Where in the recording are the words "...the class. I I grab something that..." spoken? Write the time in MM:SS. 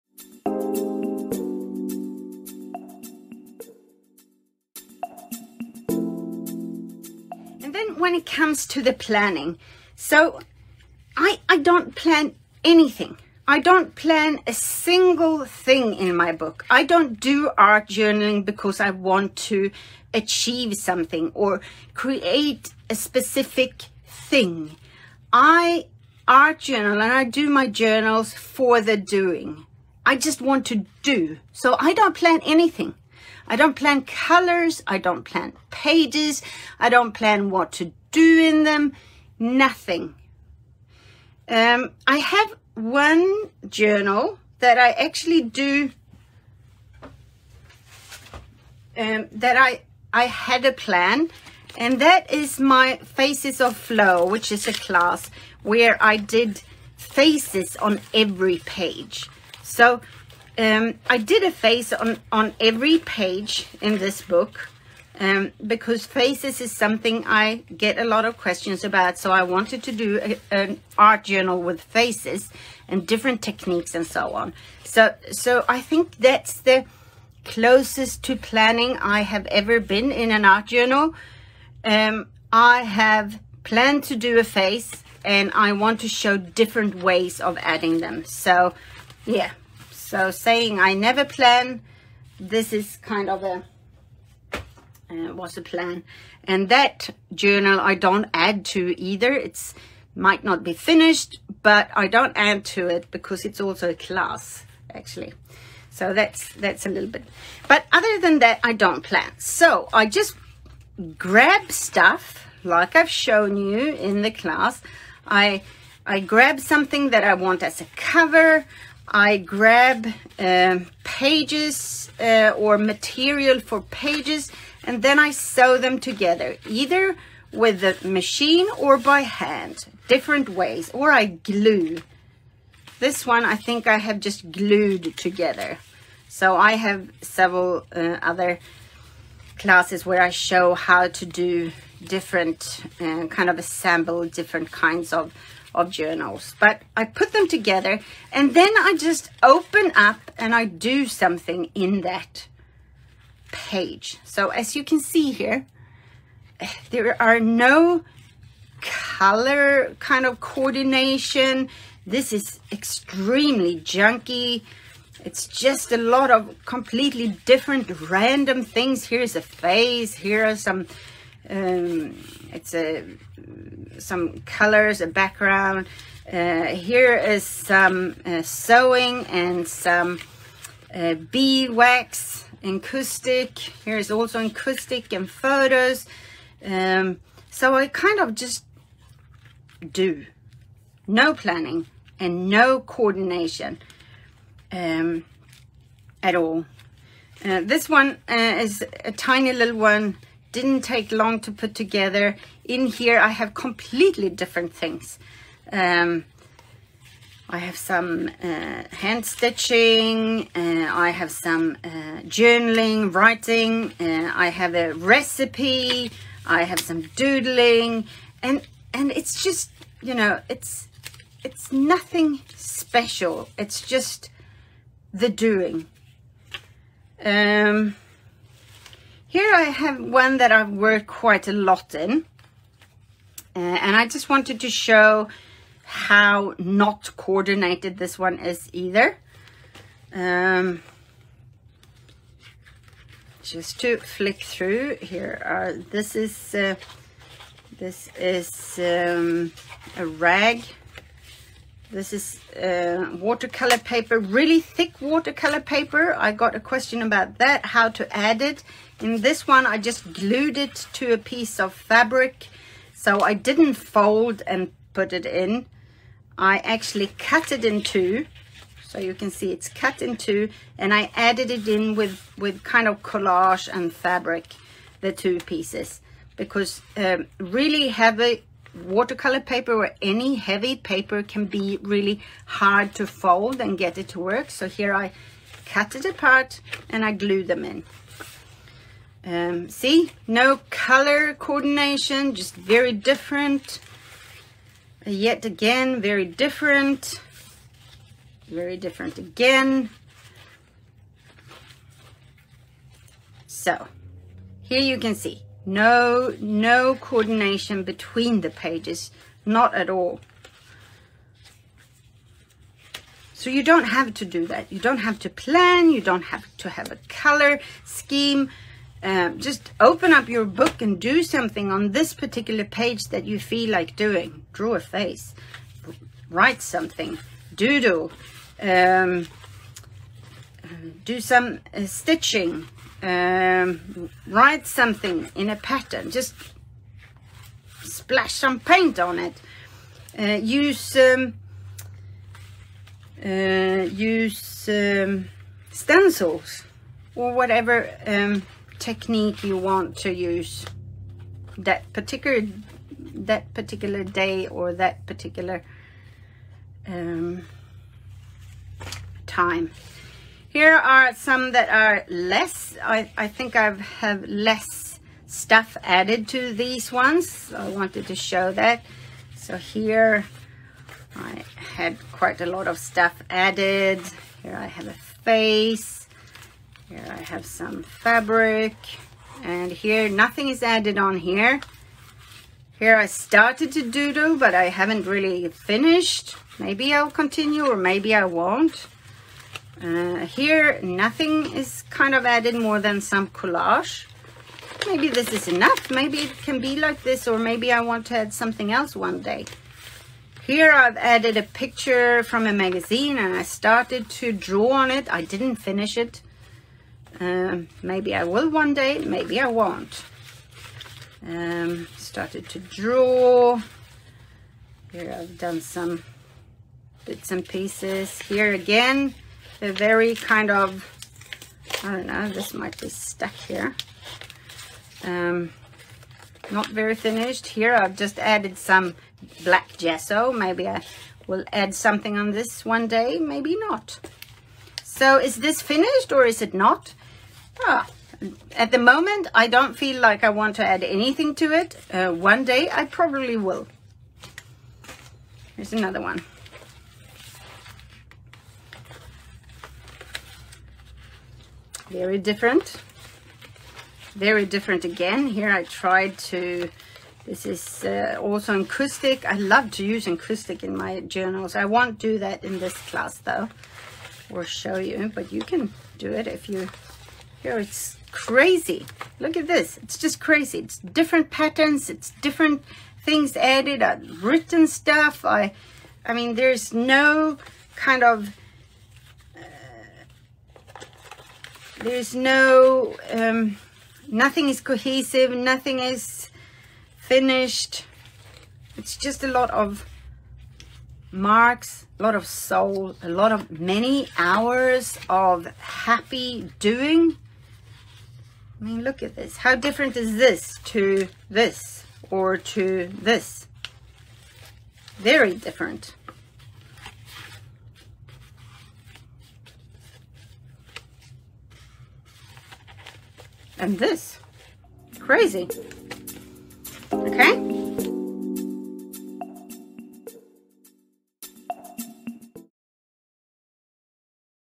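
01:54.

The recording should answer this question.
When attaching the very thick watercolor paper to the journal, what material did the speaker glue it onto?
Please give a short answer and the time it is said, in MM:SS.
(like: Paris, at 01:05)
a piece of fabric, at 04:21.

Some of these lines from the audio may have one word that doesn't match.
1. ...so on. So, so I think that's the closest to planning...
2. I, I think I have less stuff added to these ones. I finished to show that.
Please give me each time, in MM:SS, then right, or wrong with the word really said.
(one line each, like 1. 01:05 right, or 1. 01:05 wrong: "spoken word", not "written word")
1. 01:14 right
2. 06:02 wrong: "wanted", not "finished".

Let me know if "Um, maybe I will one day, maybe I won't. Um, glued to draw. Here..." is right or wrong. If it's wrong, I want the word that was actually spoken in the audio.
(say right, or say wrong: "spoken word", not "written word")
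wrong: "started", not "glued".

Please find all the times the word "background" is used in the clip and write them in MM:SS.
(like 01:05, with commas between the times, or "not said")
02:55.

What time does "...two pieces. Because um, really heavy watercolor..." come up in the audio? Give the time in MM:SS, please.
04:35.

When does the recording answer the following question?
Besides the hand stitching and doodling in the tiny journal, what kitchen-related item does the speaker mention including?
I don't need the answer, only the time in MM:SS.
03:34.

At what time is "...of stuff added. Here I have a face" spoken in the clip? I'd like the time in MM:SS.
06:12.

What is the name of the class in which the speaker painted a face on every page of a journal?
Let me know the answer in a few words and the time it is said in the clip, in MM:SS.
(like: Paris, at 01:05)
Faces of Flow, at 00:52.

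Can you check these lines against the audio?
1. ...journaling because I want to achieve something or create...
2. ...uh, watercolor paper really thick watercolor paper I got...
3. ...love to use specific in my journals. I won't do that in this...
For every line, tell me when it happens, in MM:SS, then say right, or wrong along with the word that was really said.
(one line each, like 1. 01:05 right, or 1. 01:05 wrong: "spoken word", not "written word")
1. 00:17 right
2. 04:12 right
3. 07:39 wrong: "encaustic", not "specific".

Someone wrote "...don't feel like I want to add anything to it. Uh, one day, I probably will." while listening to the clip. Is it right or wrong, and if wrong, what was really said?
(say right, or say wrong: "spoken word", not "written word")
right.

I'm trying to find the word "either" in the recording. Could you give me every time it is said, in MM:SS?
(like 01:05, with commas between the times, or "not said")
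01:38, 02:06, 03:58.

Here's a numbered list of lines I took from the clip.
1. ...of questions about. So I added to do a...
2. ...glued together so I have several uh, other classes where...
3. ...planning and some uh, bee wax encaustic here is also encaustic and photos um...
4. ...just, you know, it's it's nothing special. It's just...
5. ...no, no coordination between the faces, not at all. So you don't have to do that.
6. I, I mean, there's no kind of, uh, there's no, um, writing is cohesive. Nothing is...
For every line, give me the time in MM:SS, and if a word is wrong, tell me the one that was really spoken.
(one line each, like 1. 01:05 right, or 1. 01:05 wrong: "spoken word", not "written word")
1. 01:08 wrong: "wanted", not "added"
2. 02:14 right
3. 02:58 wrong: "sewing", not "planning"
4. 03:39 right
5. 05:05 wrong: "pages", not "faces"
6. 07:55 wrong: "nothing", not "writing".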